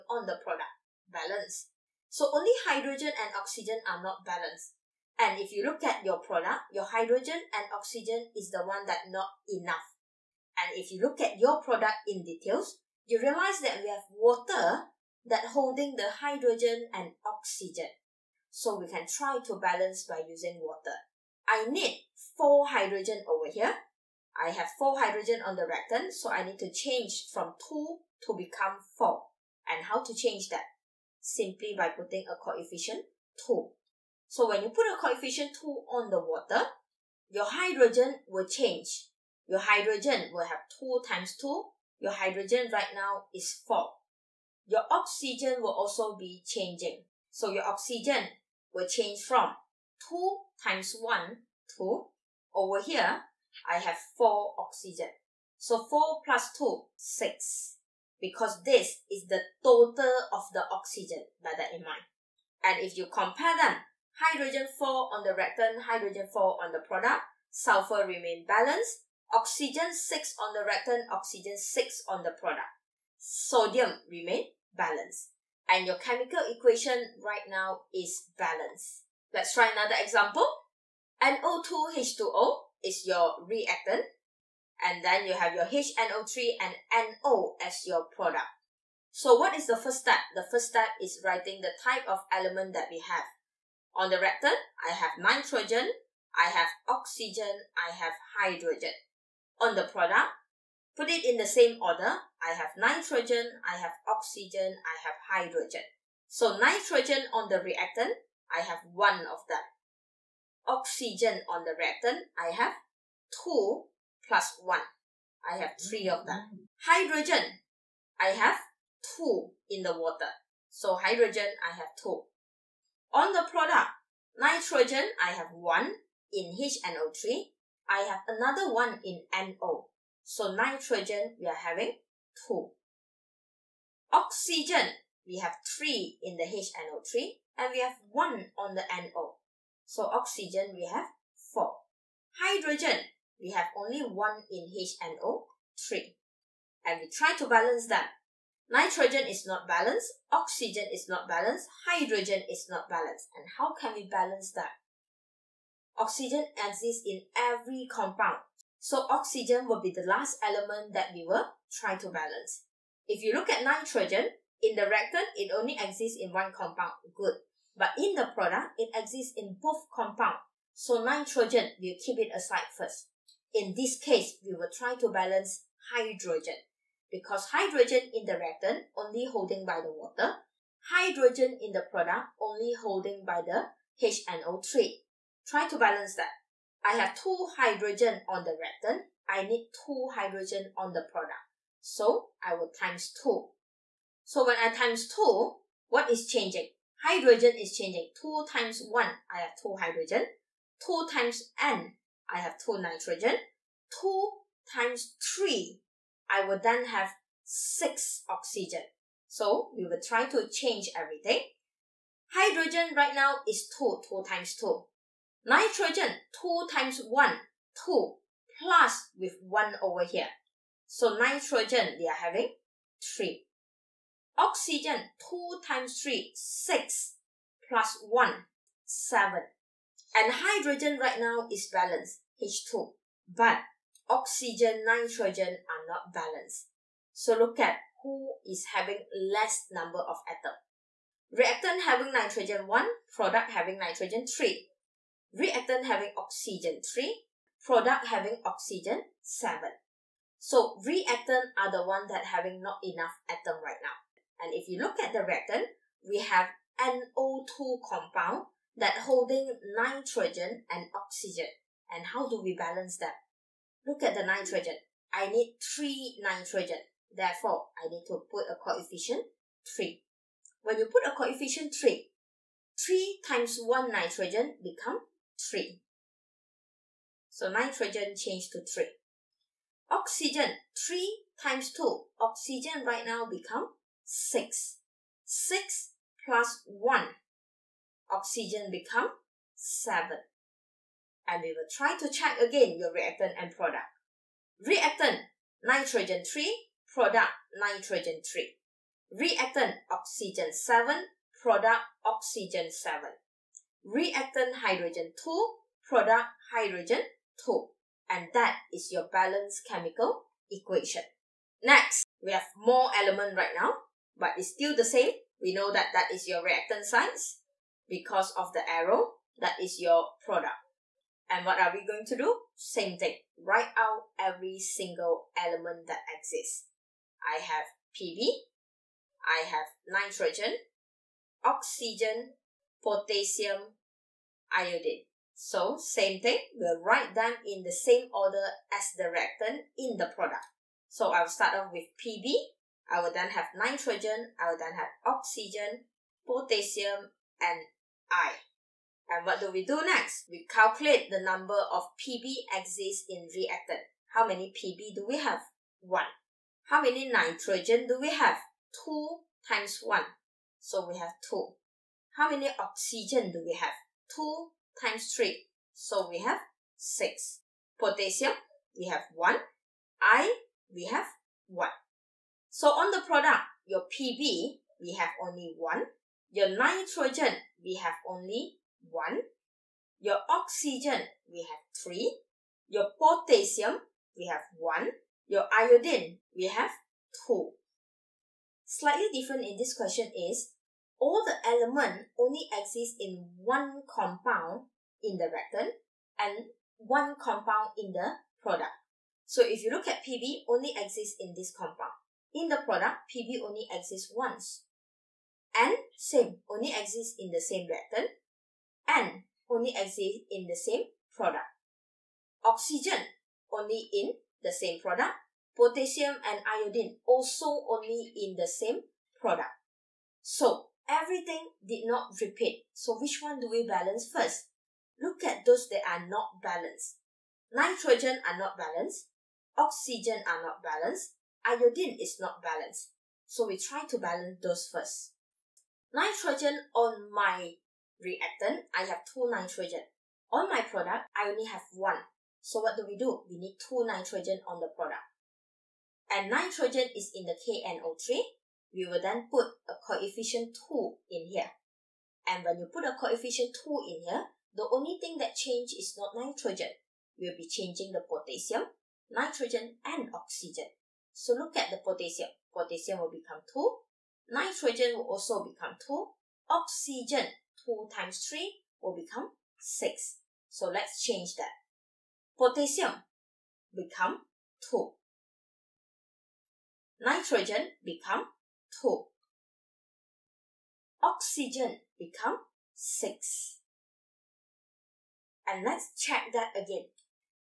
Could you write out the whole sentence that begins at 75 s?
And your chemical equation right now is balanced.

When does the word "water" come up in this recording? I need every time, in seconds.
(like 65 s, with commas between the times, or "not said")
14 s, 20 s, 36 s, 119 s, 179 s.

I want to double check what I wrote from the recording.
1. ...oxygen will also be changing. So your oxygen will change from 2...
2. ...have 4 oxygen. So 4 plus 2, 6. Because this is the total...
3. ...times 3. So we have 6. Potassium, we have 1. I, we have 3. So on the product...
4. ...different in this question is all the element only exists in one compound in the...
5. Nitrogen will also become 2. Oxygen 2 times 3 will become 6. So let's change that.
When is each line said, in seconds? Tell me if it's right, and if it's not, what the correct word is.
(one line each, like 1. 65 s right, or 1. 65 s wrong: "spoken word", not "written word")
1. 44 s right
2. 53 s right
3. 364 s wrong: "1", not "3"
4. 389 s right
5. 464 s right.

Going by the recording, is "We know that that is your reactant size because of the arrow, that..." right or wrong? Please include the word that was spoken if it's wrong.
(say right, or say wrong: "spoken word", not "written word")
right.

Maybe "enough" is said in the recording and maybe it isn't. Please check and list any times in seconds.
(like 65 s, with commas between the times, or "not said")
9 s, 252 s.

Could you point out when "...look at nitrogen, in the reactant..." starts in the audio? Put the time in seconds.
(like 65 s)
163 s.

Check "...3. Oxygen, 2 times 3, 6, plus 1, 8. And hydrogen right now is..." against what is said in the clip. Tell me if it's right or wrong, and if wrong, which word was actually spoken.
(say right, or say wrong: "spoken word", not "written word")
wrong: "7", not "8".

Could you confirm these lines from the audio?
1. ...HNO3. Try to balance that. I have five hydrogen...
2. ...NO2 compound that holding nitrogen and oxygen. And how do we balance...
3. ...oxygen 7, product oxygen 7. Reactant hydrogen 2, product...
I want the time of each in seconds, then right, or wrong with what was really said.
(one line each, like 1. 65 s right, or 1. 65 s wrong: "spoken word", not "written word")
1. 184 s wrong: "two", not "five"
2. 256 s right
3. 299 s right.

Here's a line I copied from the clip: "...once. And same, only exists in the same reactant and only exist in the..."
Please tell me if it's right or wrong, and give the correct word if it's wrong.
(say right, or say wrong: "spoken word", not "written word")
right.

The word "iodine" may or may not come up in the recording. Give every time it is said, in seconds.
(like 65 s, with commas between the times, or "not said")
334 s, 385 s, 416 s, 431 s.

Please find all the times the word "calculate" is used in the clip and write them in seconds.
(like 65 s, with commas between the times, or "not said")
350 s.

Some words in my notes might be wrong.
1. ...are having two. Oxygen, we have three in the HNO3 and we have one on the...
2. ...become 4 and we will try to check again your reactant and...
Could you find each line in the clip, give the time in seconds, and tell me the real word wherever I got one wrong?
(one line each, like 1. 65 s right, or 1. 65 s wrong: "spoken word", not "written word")
1. 131 s right
2. 288 s wrong: "7", not "4".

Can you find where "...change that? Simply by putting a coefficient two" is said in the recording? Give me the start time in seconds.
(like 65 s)
30 s.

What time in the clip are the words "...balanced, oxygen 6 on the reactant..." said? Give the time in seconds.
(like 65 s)
68 s.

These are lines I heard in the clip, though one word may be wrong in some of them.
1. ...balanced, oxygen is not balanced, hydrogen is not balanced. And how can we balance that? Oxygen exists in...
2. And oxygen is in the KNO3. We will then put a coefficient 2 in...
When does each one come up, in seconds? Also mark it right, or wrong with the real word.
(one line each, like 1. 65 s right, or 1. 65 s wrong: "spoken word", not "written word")
1. 149 s right
2. 446 s wrong: "nitrogen", not "oxygen".